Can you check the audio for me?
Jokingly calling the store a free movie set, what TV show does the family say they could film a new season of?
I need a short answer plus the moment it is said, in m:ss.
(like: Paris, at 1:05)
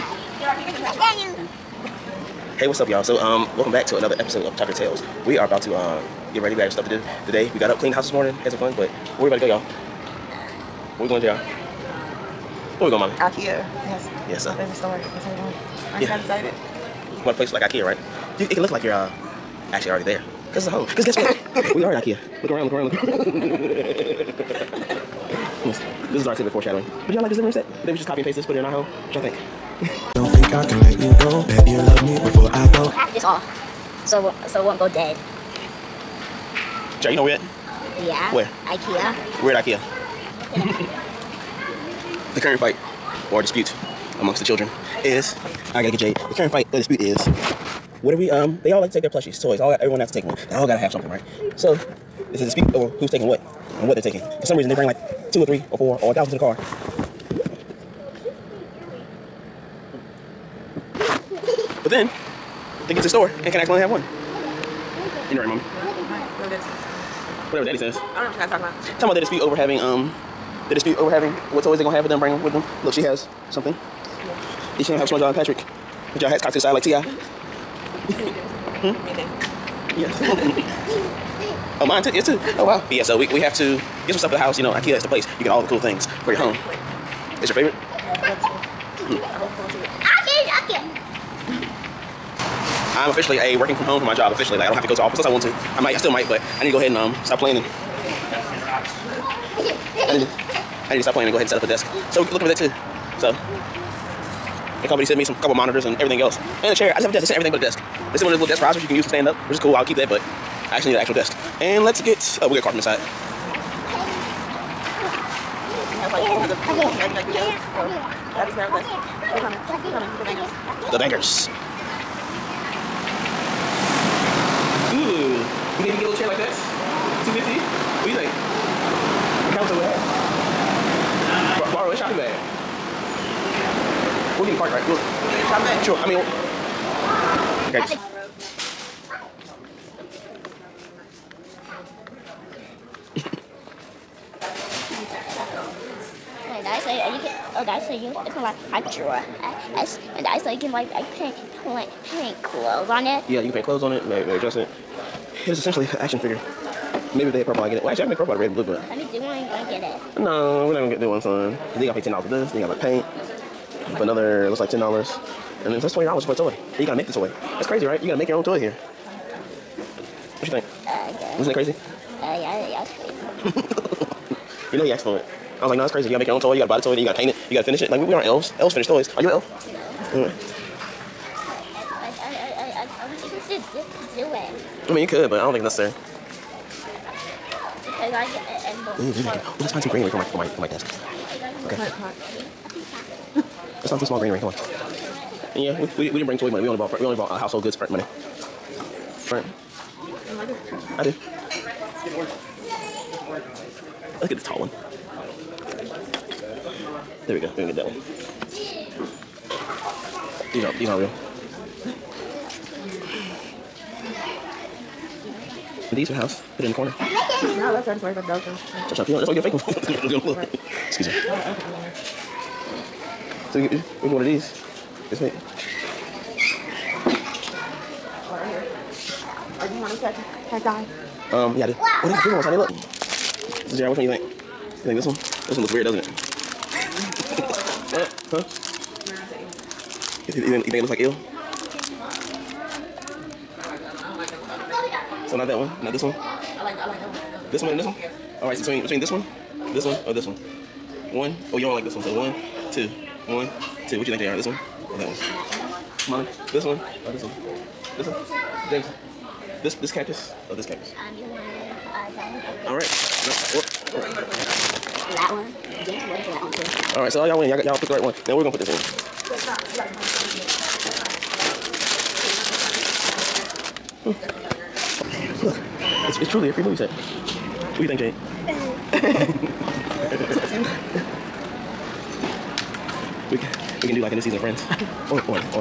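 Friends, at 4:44.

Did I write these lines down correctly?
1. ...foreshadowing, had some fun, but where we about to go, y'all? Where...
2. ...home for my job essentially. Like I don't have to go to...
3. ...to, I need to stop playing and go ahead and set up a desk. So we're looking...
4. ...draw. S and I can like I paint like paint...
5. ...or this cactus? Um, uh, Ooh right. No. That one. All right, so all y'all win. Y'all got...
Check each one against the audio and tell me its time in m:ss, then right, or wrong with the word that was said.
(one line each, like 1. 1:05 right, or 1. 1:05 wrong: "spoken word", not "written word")
1. 0:08 wrong: "morning", not "foreshadowing"
2. 1:33 wrong: "officially", not "essentially"
3. 1:40 right
4. 2:28 right
5. 4:20 wrong: "All", not "Ooh".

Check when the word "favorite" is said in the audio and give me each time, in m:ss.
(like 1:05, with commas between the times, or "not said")
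0:14, 1:27.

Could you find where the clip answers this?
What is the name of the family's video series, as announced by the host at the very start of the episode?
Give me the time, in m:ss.
0:04.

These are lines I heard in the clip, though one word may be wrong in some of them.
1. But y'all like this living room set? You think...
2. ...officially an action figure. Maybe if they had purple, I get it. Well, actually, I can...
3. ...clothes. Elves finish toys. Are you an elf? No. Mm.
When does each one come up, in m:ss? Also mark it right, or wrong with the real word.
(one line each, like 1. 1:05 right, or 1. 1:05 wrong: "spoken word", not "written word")
1. 0:27 right
2. 2:35 wrong: "essentially", not "officially"
3. 2:58 wrong: "elves", not "clothes".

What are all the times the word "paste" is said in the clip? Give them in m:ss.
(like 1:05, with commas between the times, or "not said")
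0:28.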